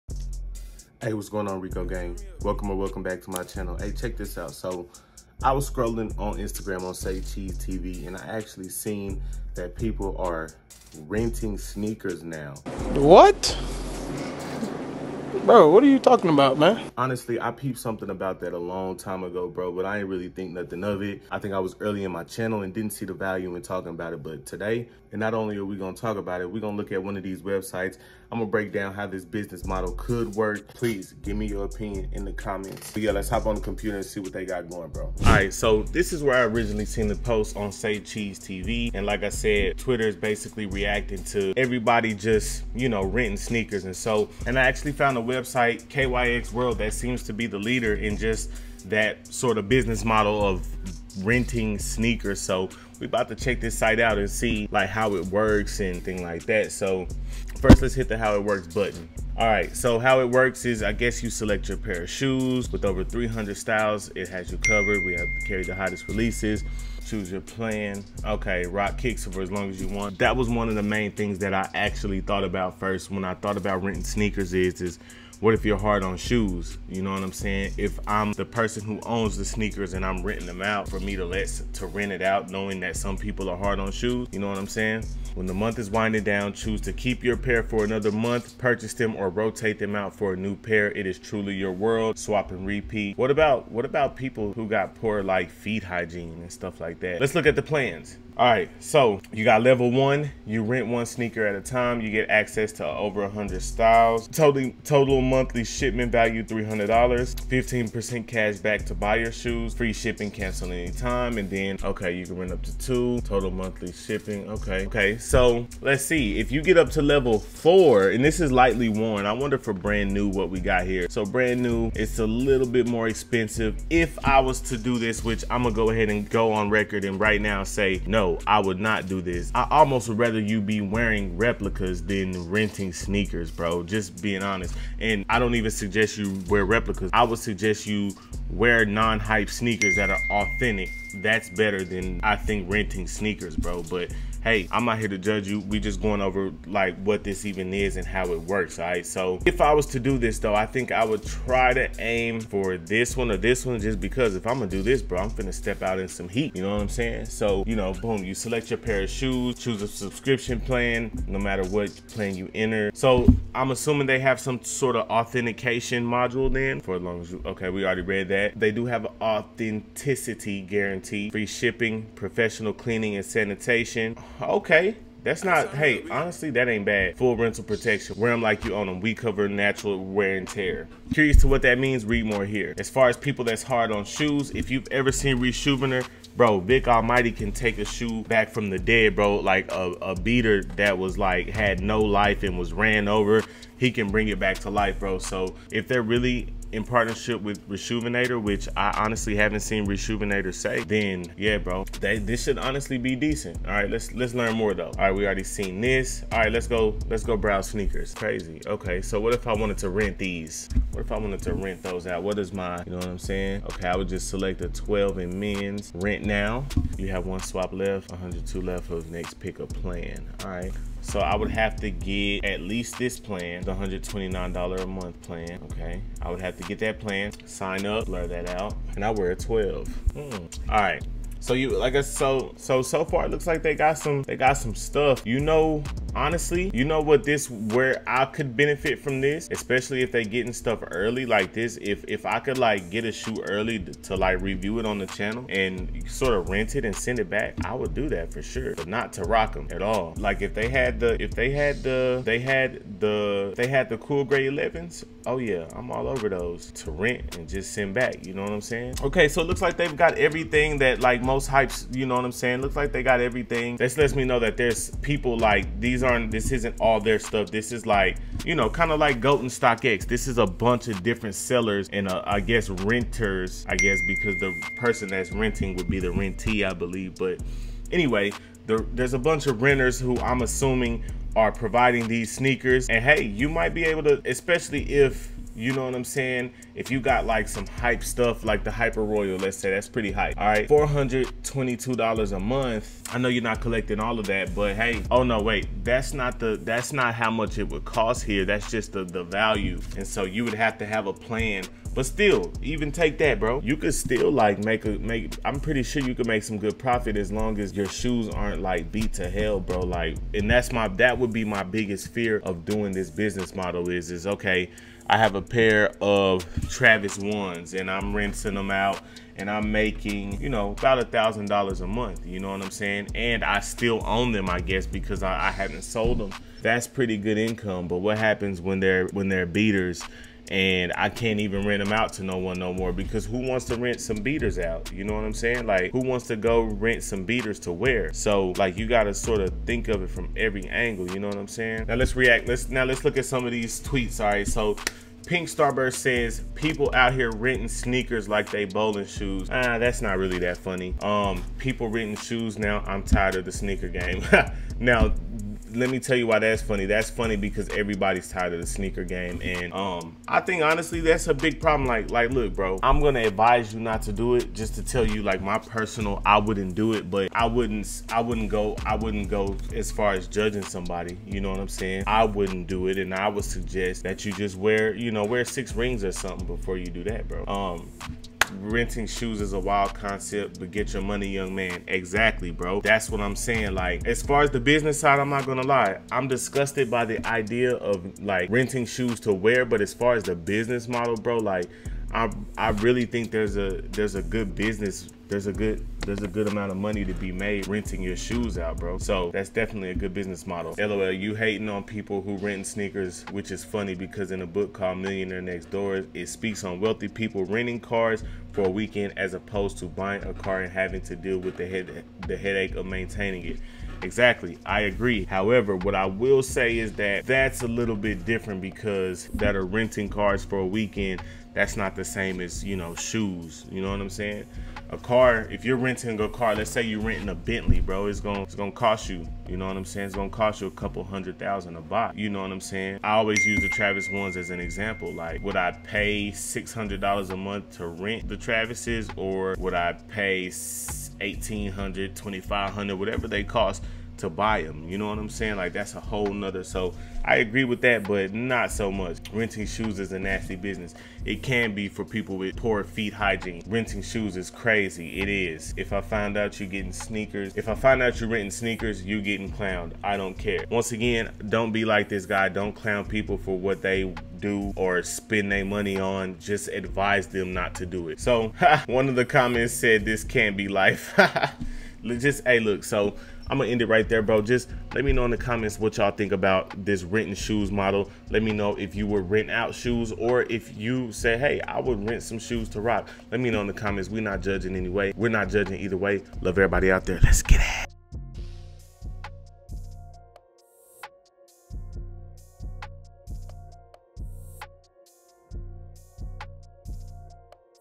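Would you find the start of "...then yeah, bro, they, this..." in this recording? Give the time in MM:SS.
03:20.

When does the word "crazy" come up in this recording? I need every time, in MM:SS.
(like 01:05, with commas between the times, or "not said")
03:28, 07:34.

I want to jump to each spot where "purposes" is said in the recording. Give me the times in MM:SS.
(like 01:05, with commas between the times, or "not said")
not said.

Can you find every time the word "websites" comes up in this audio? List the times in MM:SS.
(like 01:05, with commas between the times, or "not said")
00:27, 00:45.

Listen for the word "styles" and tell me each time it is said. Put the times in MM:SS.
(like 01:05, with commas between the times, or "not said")
01:03, 01:43.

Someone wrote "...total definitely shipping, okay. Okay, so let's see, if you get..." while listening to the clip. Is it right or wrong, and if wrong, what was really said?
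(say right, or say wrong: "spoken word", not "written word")
wrong: "monthly", not "definitely".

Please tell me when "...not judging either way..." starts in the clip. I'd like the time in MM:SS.
08:05.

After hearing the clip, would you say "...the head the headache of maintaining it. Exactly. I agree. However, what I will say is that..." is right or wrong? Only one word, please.
right.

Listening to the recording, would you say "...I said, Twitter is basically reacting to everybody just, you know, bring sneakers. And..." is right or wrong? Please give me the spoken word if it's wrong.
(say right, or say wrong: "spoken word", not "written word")
wrong: "renting", not "bring".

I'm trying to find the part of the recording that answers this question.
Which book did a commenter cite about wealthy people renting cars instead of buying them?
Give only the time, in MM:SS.
06:44.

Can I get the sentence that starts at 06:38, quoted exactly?
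So that's definitely a good business model.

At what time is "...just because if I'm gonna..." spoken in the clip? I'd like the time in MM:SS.
02:33.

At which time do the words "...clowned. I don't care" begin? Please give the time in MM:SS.
07:39.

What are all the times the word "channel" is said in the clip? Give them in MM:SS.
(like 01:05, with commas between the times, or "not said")
00:03, 00:22, 04:05.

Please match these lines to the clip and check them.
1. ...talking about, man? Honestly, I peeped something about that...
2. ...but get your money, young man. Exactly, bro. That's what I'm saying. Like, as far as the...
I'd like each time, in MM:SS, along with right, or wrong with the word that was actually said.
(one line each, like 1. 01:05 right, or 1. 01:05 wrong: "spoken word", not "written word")
1. 00:15 right
2. 06:20 right.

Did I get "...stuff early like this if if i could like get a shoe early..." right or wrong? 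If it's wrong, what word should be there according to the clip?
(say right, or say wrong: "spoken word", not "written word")
right.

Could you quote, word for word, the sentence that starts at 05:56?
That's funny because everybody's tired of the sneaker game, and um, I think honestly that's a big problem.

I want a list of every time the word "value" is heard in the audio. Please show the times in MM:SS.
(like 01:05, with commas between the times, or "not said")
00:23, 01:46, 04:59.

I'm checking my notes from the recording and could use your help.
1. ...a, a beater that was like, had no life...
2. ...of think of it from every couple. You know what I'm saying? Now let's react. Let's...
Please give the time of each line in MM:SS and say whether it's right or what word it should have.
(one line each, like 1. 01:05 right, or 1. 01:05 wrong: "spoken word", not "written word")
1. 03:09 right
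2. 05:39 wrong: "angle", not "couple".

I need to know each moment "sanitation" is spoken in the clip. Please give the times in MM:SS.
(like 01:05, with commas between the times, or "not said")
02:53.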